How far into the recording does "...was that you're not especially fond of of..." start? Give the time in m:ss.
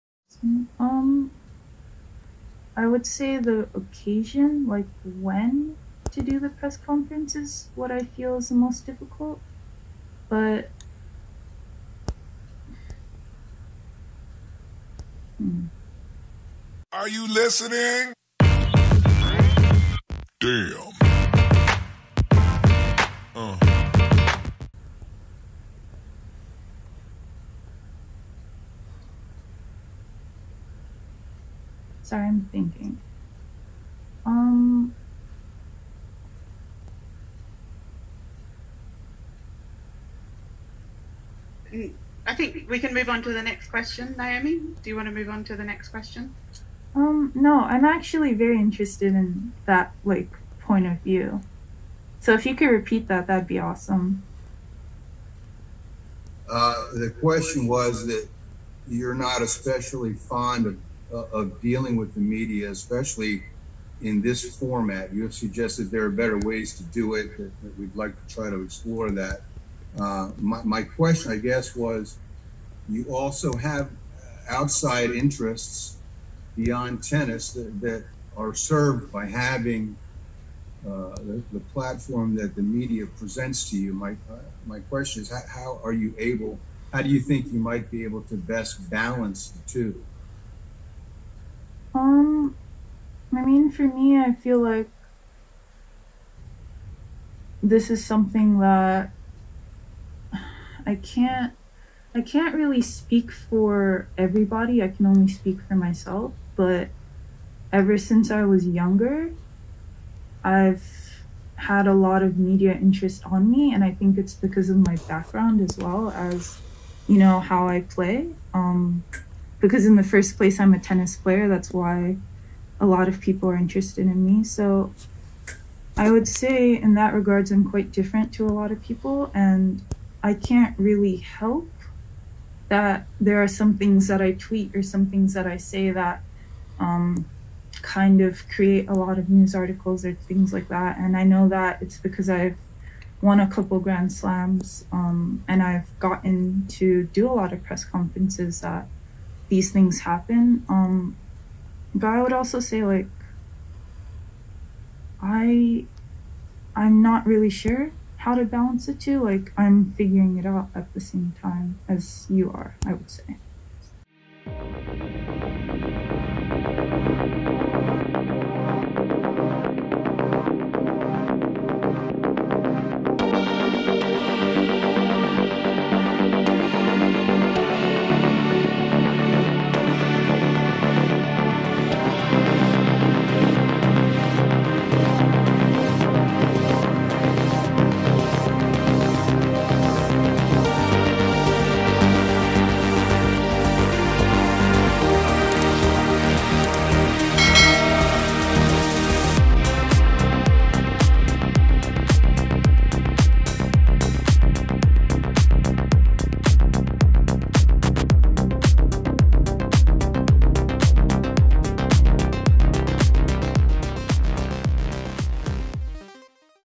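0:57.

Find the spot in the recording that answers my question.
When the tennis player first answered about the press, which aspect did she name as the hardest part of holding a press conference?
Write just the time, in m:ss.
0:03.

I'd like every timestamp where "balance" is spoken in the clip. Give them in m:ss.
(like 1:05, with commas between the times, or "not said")
1:28, 2:38.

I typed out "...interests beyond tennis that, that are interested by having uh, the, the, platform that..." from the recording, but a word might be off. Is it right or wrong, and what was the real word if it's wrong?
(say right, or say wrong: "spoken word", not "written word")
wrong: "served", not "interested".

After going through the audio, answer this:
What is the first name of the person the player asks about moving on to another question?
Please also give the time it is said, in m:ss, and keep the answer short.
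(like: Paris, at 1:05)
Naomi, at 0:44.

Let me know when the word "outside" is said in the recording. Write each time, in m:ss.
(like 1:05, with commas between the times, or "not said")
1:14.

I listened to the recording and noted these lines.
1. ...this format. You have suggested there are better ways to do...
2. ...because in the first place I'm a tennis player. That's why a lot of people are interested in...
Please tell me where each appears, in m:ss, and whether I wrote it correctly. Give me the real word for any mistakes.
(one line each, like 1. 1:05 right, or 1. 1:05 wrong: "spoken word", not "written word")
1. 1:04 right
2. 1:59 right.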